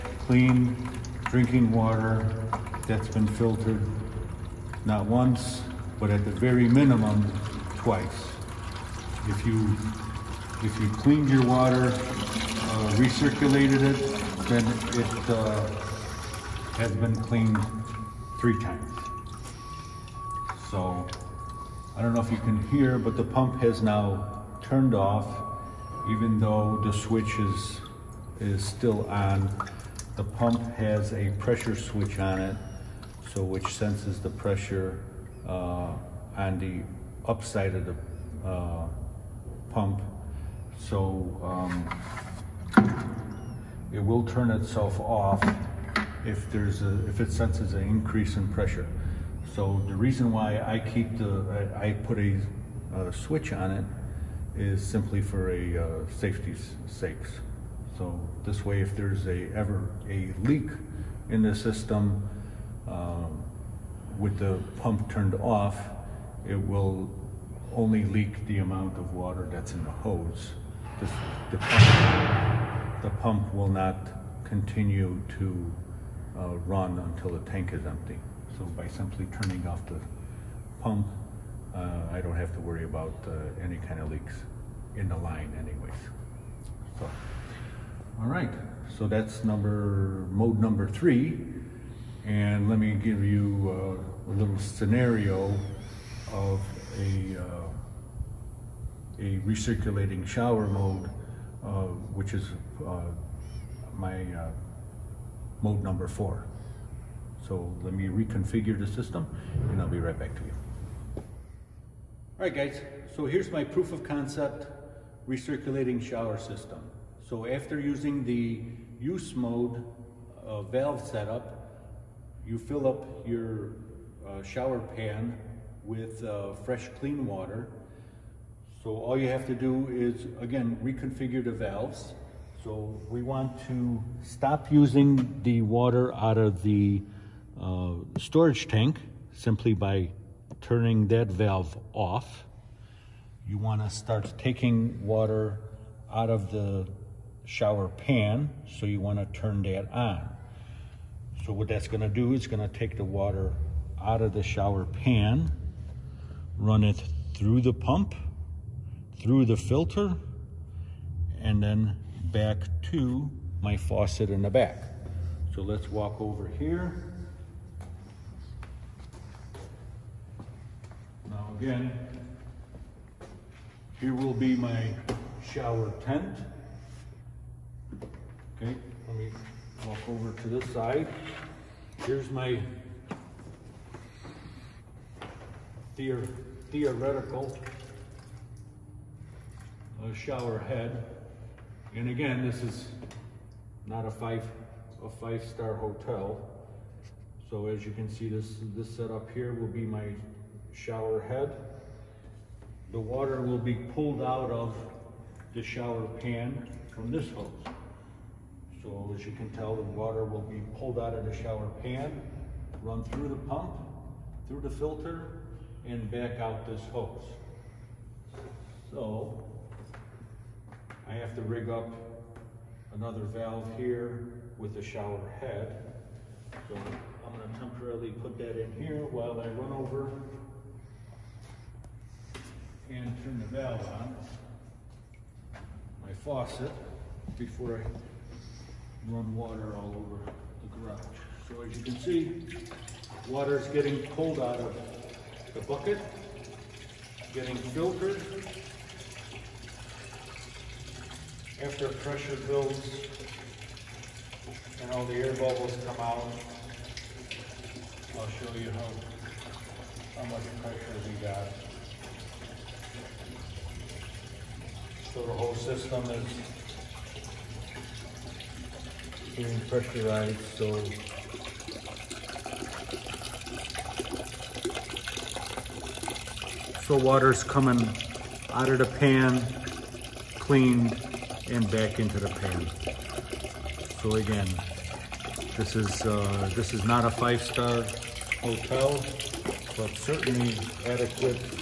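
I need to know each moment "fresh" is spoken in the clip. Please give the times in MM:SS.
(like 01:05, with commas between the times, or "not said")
02:06.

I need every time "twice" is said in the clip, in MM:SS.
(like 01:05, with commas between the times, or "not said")
00:07.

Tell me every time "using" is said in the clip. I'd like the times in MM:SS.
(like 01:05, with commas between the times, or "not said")
01:57, 02:14.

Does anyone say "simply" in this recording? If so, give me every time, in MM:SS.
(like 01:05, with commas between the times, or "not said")
00:54, 01:18, 02:19.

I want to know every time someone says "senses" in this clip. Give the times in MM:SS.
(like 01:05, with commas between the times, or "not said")
00:33, 00:47.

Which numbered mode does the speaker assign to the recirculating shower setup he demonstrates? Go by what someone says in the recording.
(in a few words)
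4.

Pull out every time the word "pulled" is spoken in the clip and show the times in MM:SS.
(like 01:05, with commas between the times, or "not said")
03:23, 03:30, 04:04.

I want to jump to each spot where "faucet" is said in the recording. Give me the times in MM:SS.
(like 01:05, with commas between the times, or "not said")
02:43, 03:56.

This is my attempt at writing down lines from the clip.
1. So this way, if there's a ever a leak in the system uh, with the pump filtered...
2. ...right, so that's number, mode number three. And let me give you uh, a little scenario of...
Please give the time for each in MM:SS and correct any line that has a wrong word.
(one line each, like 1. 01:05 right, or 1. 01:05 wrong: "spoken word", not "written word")
1. 00:57 wrong: "turned", not "filtered"
2. 01:28 right.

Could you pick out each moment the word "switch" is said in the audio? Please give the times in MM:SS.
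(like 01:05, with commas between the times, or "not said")
00:26, 00:31, 00:53.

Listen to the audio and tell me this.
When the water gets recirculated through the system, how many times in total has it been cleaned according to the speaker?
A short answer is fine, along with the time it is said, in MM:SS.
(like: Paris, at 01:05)
3, at 00:18.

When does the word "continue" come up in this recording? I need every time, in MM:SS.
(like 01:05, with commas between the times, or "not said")
01:14.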